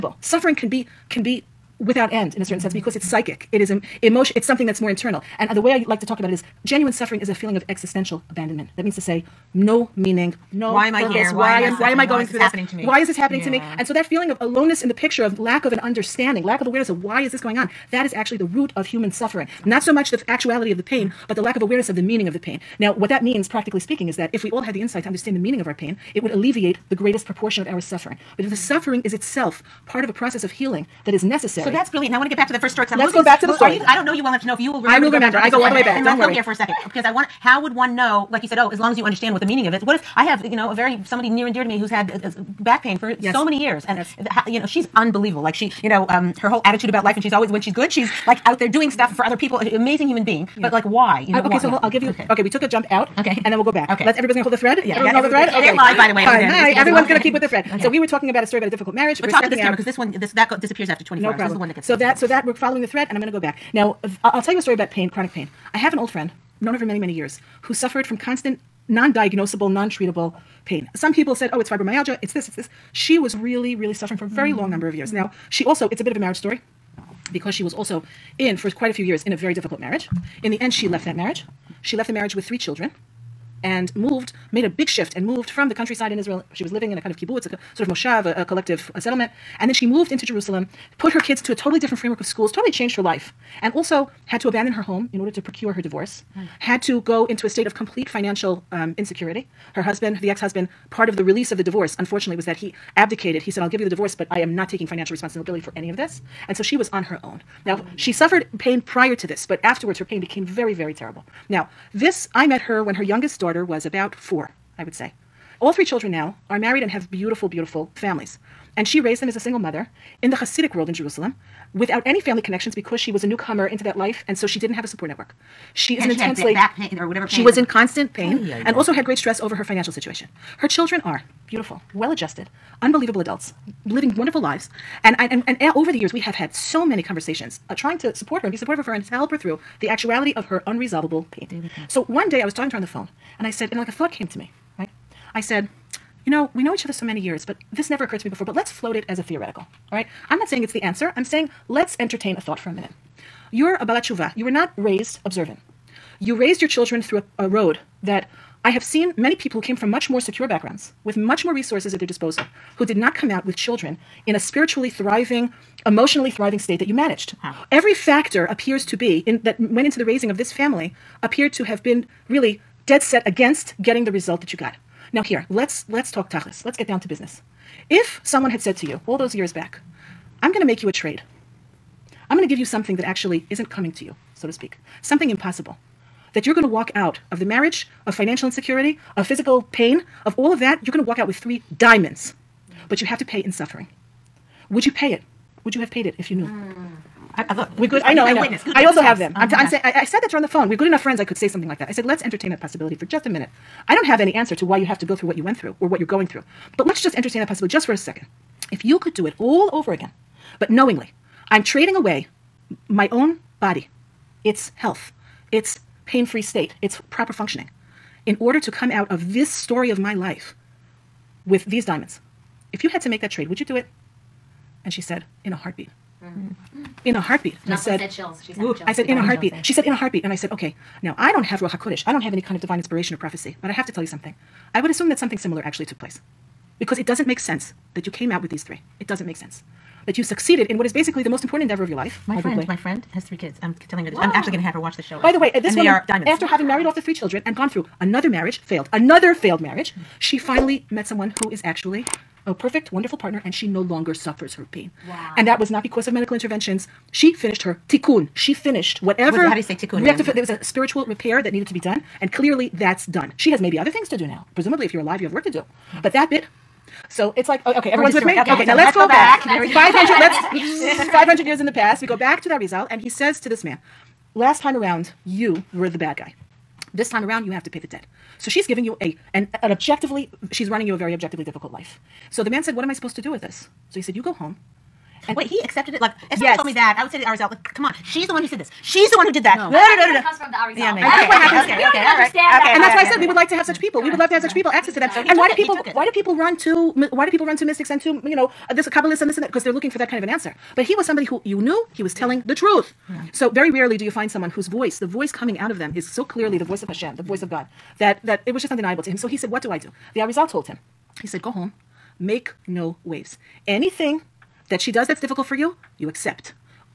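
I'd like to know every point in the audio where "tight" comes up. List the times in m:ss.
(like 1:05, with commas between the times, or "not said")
not said.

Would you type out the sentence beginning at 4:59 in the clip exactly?
Because they're looking for that kind of an answer.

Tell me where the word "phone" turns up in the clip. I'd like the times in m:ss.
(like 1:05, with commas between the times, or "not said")
2:22, 3:20.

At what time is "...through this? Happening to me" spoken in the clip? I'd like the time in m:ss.
0:12.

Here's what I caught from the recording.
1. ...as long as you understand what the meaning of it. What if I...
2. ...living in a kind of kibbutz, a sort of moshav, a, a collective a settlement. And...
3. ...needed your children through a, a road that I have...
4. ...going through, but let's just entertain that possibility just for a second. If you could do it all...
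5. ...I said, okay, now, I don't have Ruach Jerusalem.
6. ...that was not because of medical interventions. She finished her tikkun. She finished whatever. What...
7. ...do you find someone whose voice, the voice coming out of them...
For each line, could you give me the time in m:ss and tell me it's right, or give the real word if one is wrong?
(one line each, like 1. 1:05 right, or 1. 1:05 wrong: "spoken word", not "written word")
1. 0:38 right
2. 1:26 right
3. 2:36 wrong: "raised", not "needed"
4. 3:26 right
5. 3:50 wrong: "HaKodesh", not "Jerusalem"
6. 4:15 right
7. 5:03 right.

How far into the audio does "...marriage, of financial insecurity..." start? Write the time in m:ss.
3:07.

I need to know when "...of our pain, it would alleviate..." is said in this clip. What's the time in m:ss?
0:25.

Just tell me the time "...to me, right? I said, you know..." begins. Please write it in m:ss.
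2:24.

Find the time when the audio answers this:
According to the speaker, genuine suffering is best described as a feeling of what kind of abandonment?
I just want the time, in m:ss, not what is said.
0:07.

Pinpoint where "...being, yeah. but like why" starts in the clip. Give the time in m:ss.
0:50.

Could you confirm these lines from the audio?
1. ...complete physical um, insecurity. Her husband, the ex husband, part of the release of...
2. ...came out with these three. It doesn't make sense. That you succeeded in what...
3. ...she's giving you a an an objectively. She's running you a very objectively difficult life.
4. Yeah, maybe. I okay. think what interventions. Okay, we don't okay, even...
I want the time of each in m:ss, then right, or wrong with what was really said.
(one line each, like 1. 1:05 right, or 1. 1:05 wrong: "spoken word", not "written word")
1. 1:37 wrong: "financial", not "physical"
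2. 3:58 right
3. 4:38 right
4. 4:50 wrong: "happens", not "interventions".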